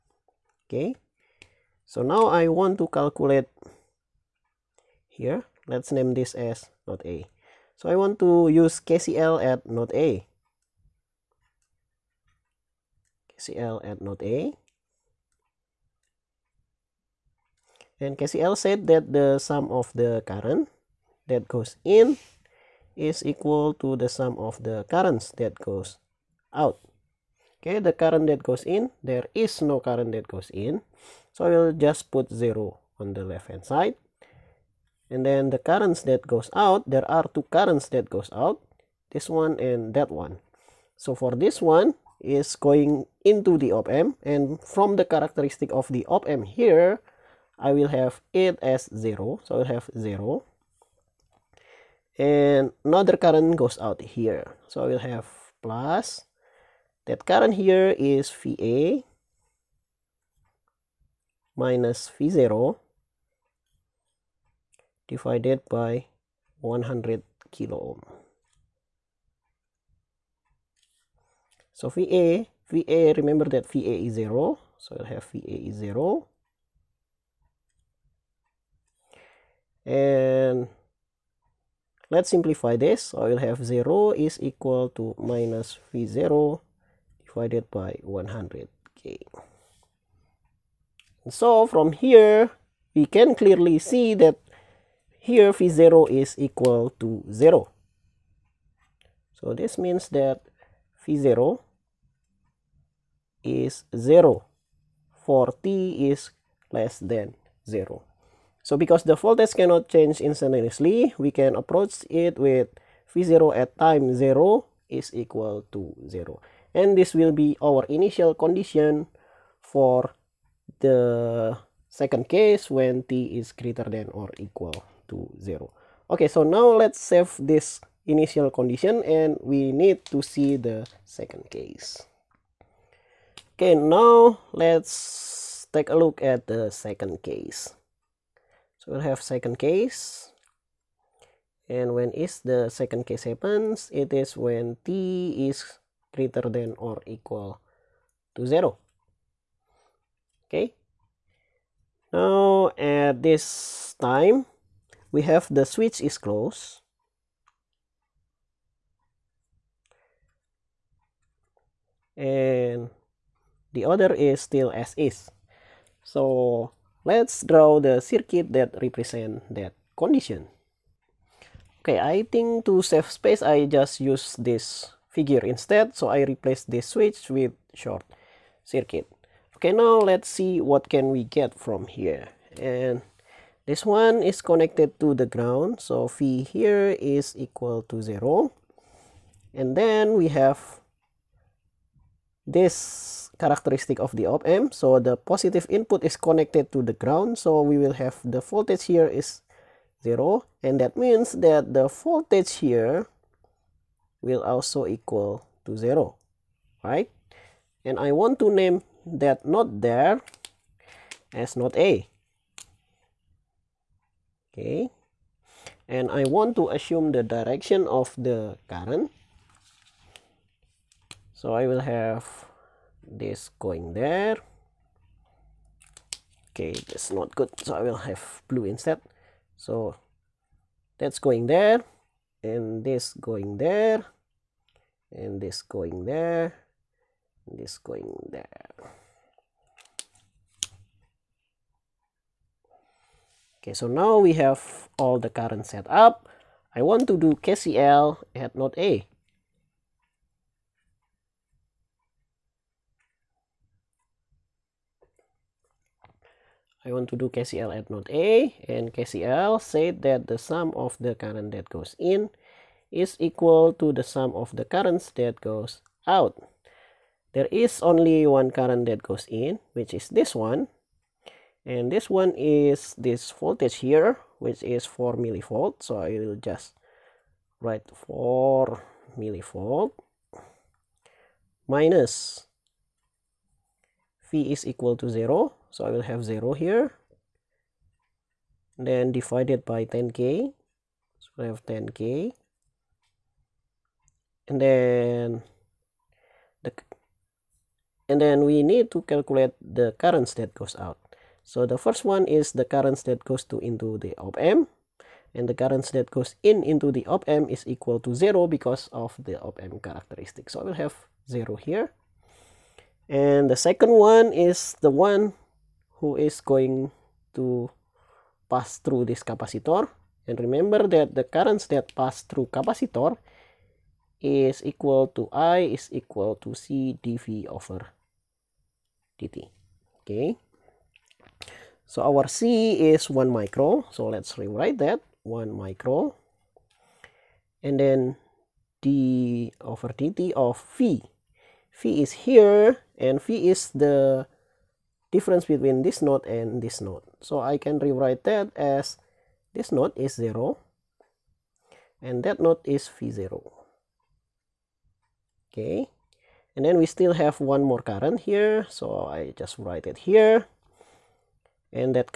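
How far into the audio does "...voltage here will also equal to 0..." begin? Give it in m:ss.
3:21.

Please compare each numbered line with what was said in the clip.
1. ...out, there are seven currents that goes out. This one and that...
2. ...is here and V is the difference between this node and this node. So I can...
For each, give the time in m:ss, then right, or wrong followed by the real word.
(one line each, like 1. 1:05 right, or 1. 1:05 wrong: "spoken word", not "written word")
1. 0:36 wrong: "two", not "seven"
2. 5:42 right.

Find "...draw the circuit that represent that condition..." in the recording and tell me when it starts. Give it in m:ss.
2:47.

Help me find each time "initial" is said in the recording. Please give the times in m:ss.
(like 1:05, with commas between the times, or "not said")
1:57, 2:08.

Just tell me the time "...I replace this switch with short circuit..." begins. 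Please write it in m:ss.
2:56.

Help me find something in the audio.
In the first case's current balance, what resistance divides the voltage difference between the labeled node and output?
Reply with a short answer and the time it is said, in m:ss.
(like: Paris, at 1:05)
100 kilo ohm, at 1:06.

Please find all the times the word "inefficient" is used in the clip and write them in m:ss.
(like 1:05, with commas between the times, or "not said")
not said.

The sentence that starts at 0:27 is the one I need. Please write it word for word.
Okay, the current that goes in, there is no current that goes in.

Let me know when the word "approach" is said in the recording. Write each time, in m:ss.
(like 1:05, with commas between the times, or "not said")
1:51.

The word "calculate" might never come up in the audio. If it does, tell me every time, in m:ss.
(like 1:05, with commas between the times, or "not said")
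0:02, 4:59.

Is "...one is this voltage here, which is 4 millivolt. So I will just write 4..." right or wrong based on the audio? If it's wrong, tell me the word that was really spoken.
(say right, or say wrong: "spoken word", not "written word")
right.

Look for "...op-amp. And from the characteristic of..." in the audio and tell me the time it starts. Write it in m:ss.
0:43.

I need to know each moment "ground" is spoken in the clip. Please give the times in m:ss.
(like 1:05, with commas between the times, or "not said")
3:05, 3:16.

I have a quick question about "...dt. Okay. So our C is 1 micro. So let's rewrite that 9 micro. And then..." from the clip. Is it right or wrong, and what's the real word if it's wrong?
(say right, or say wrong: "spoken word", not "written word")
wrong: "1", not "9".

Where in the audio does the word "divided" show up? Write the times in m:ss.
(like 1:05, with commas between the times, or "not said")
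1:05, 1:27, 4:49.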